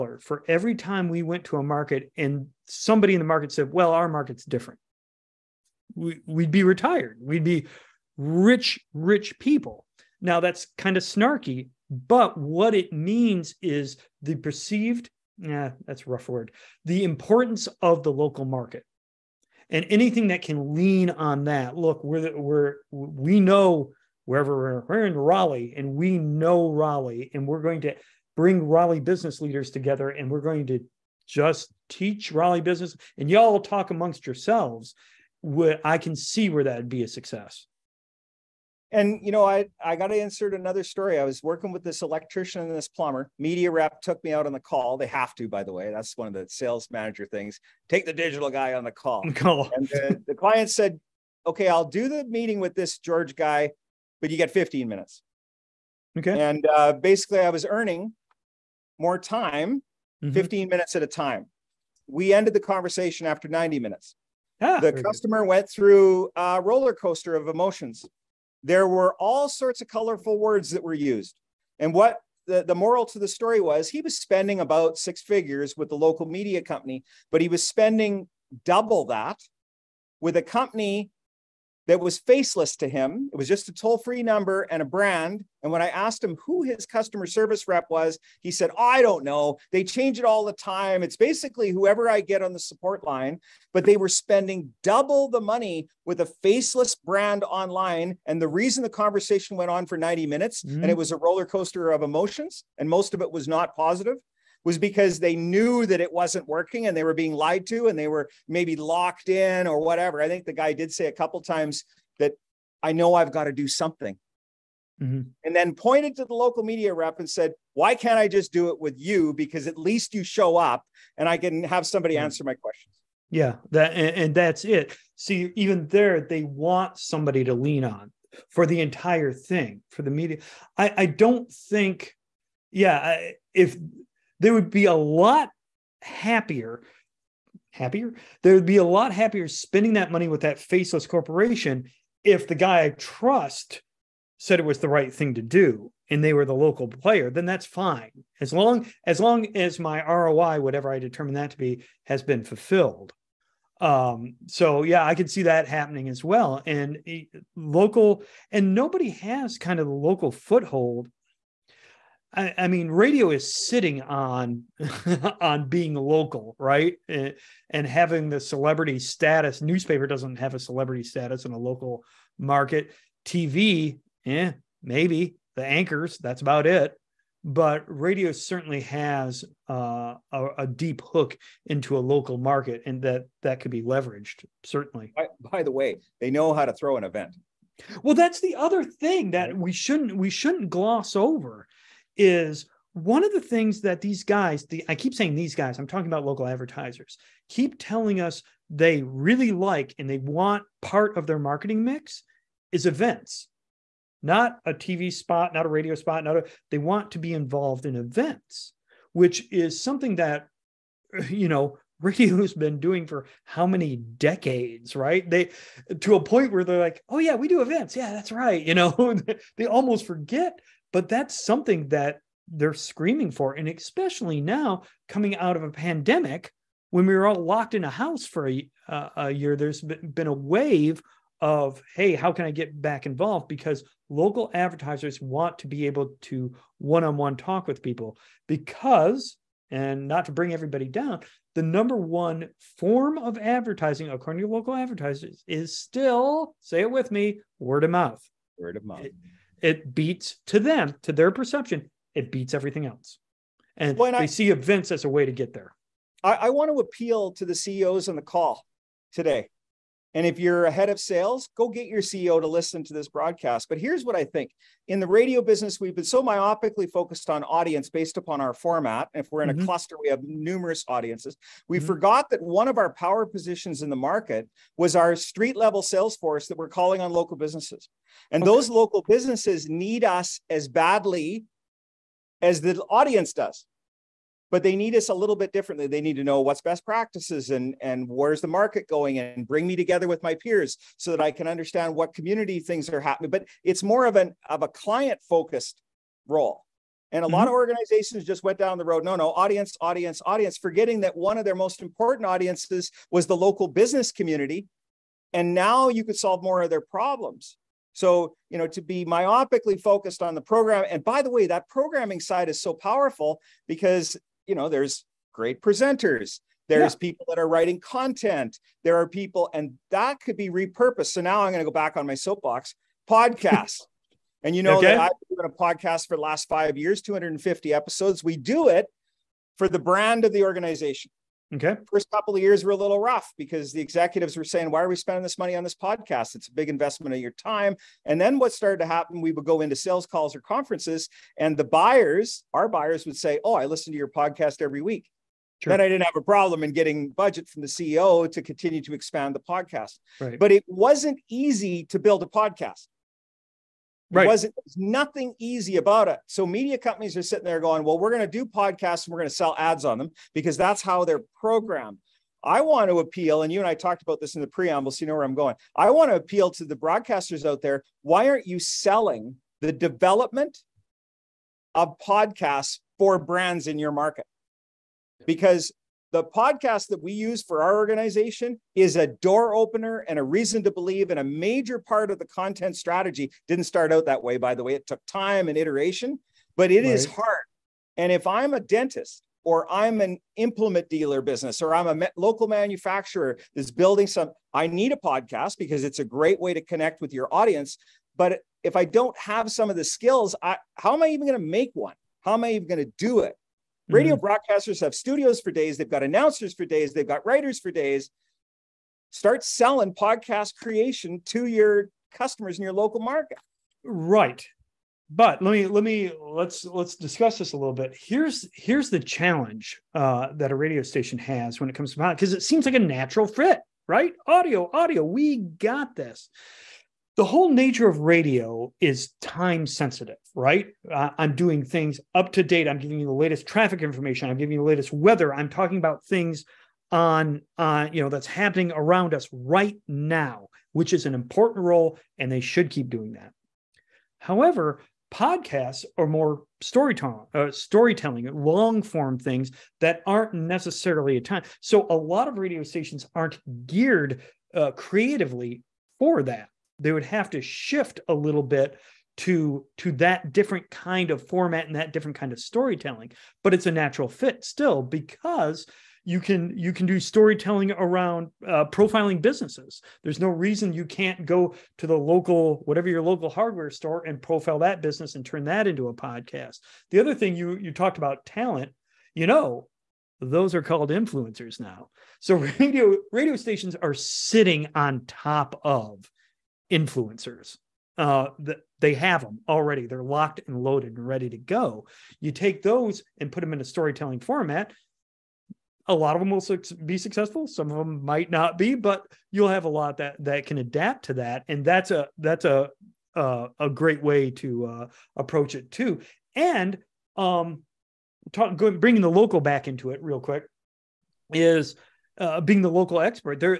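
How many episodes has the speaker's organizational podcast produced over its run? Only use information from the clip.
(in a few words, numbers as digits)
250.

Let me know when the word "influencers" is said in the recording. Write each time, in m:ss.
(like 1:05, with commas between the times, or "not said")
8:00, 8:06.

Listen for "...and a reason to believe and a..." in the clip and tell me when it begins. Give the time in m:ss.
6:20.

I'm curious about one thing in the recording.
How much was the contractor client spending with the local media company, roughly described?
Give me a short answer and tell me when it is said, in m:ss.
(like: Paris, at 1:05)
six figures, at 1:14.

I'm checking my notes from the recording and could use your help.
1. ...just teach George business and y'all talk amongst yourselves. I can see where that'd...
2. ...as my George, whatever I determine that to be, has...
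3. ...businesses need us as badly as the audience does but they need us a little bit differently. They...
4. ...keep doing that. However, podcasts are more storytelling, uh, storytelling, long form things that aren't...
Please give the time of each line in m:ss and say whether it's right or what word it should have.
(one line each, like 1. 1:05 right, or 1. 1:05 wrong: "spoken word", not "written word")
1. 0:31 wrong: "Raleigh", not "George"
2. 2:29 wrong: "ROI", not "George"
3. 4:39 right
4. 7:22 right.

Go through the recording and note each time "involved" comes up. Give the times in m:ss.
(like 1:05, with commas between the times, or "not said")
3:27, 3:53.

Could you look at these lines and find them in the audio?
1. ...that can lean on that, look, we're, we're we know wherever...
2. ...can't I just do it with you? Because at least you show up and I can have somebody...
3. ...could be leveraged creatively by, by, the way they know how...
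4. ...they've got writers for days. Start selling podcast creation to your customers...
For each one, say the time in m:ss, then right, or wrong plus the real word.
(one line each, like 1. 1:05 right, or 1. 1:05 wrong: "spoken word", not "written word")
1. 0:20 right
2. 1:57 right
3. 3:03 wrong: "certainly", not "creatively"
4. 6:46 right.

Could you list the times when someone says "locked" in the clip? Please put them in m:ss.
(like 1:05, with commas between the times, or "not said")
1:48, 3:47, 8:10.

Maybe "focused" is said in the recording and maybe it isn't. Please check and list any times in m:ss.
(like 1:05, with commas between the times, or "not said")
4:26, 4:55, 5:09.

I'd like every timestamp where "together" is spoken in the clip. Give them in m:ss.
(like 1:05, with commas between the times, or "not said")
0:29, 4:49.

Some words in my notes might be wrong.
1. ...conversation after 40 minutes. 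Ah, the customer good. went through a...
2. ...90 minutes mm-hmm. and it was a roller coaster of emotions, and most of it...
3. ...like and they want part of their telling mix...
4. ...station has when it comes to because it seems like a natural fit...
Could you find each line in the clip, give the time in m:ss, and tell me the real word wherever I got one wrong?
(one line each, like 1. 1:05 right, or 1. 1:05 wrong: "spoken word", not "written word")
1. 1:02 wrong: "90", not "40"
2. 1:39 right
3. 3:19 wrong: "marketing", not "telling"
4. 7:00 right.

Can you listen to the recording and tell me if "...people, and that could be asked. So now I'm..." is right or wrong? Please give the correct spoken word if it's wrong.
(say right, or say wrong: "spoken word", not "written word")
wrong: "repurposed", not "asked".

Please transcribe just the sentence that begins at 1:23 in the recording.
It was just a toll free number and a brand.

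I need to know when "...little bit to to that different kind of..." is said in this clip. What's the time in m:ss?
7:38.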